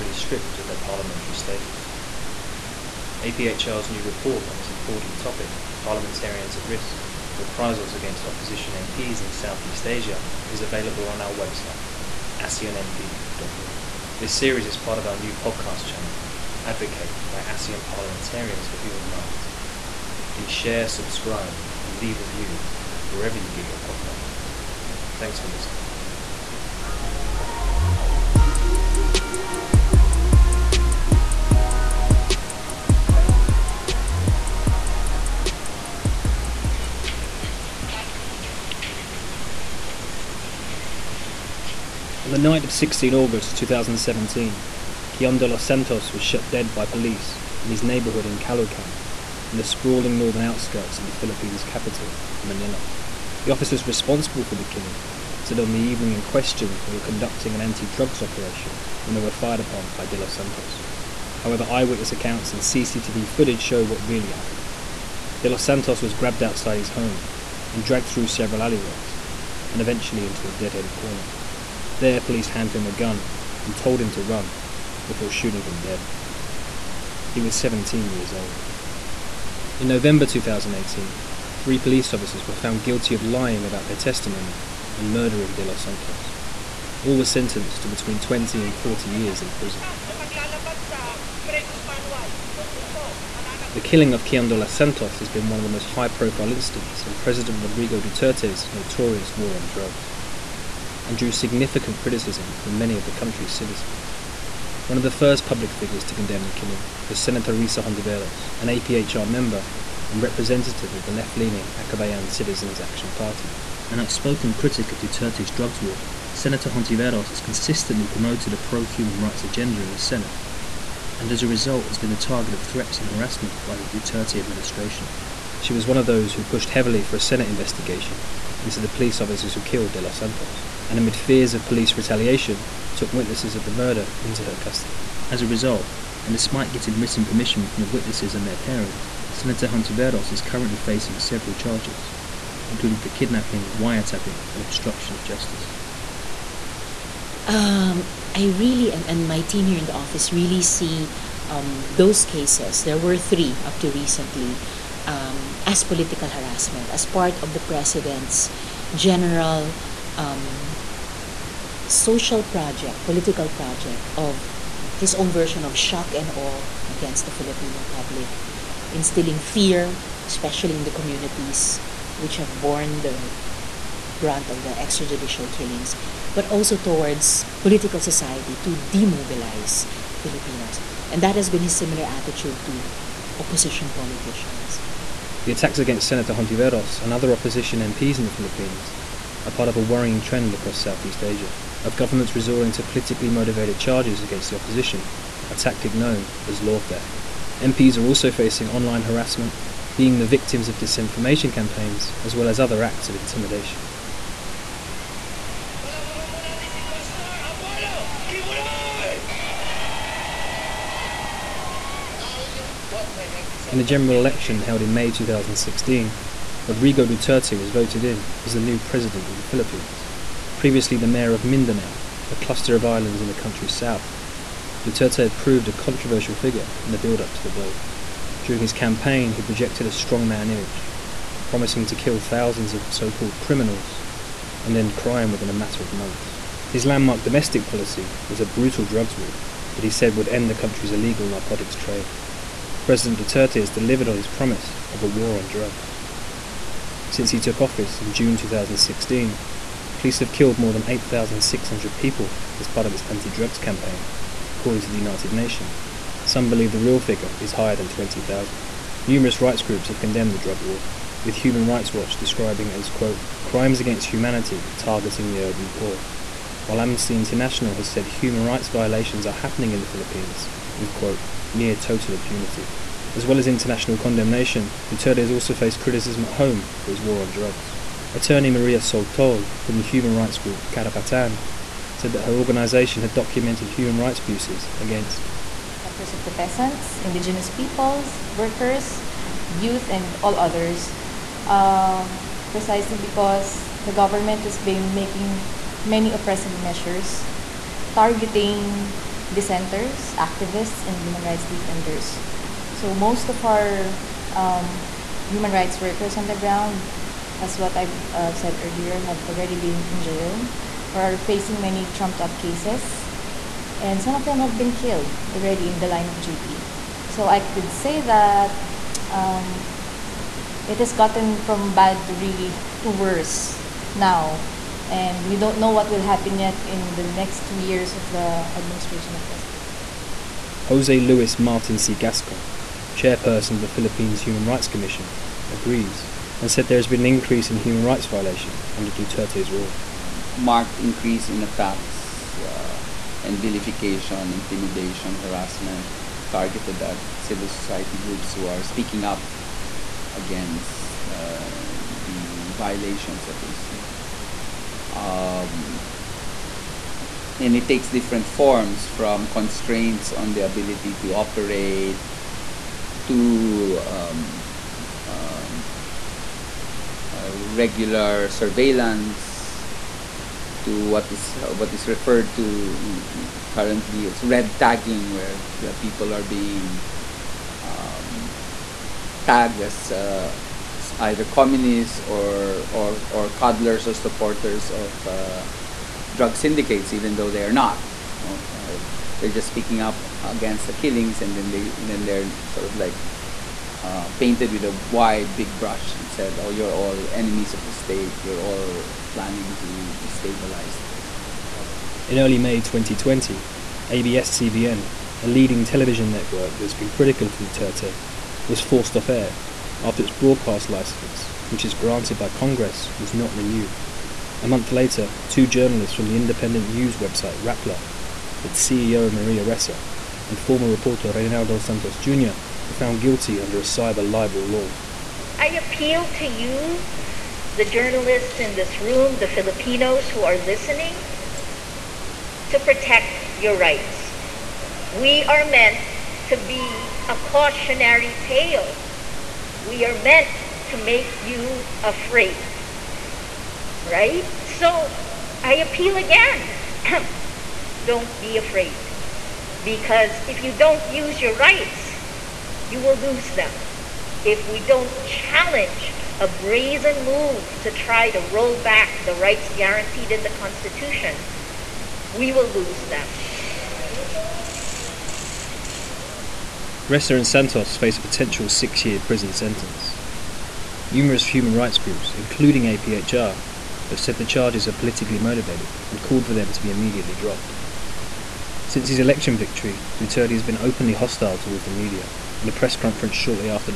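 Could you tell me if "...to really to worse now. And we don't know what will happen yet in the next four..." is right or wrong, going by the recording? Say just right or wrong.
wrong.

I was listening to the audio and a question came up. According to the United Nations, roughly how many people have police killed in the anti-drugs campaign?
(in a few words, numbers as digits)
more than 8,600.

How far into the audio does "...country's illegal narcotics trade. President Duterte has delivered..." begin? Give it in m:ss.
4:00.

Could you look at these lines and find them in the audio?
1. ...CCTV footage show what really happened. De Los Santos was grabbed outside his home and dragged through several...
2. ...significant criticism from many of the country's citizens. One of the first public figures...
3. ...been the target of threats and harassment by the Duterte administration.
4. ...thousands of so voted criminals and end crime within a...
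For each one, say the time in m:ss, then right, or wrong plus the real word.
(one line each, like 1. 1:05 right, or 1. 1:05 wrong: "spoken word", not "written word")
1. 1:02 right
2. 1:41 right
3. 2:01 right
4. 3:52 wrong: "called", not "voted".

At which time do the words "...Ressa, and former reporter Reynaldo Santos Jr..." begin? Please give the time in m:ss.
6:59.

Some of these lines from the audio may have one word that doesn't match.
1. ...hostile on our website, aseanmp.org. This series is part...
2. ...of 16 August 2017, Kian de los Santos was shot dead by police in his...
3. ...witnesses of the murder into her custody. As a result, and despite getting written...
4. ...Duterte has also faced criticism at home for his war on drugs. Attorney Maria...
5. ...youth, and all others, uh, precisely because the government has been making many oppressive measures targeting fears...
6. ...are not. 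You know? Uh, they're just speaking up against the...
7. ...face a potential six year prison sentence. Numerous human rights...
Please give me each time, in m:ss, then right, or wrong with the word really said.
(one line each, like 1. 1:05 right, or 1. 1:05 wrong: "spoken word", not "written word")
1. 0:10 wrong: "available", not "hostile"
2. 0:42 right
3. 2:13 right
4. 4:34 right
5. 4:49 wrong: "dissenters", not "fears"
6. 6:27 right
7. 7:47 right.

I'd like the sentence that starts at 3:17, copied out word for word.
MPs are also facing online harassment, being the victims of disinformation campaigns, as well as other acts of intimidation.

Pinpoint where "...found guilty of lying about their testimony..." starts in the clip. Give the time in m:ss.
1:22.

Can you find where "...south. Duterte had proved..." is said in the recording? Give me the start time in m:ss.
3:43.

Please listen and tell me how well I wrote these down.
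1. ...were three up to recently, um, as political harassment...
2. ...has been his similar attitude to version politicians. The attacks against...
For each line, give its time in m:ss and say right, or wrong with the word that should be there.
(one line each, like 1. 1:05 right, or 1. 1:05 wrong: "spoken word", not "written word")
1. 2:32 right
2. 3:01 wrong: "opposition", not "version".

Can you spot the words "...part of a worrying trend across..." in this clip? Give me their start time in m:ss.
3:09.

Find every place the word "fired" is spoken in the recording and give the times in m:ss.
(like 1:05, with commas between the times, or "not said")
0:59.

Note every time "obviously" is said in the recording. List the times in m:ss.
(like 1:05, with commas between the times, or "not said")
not said.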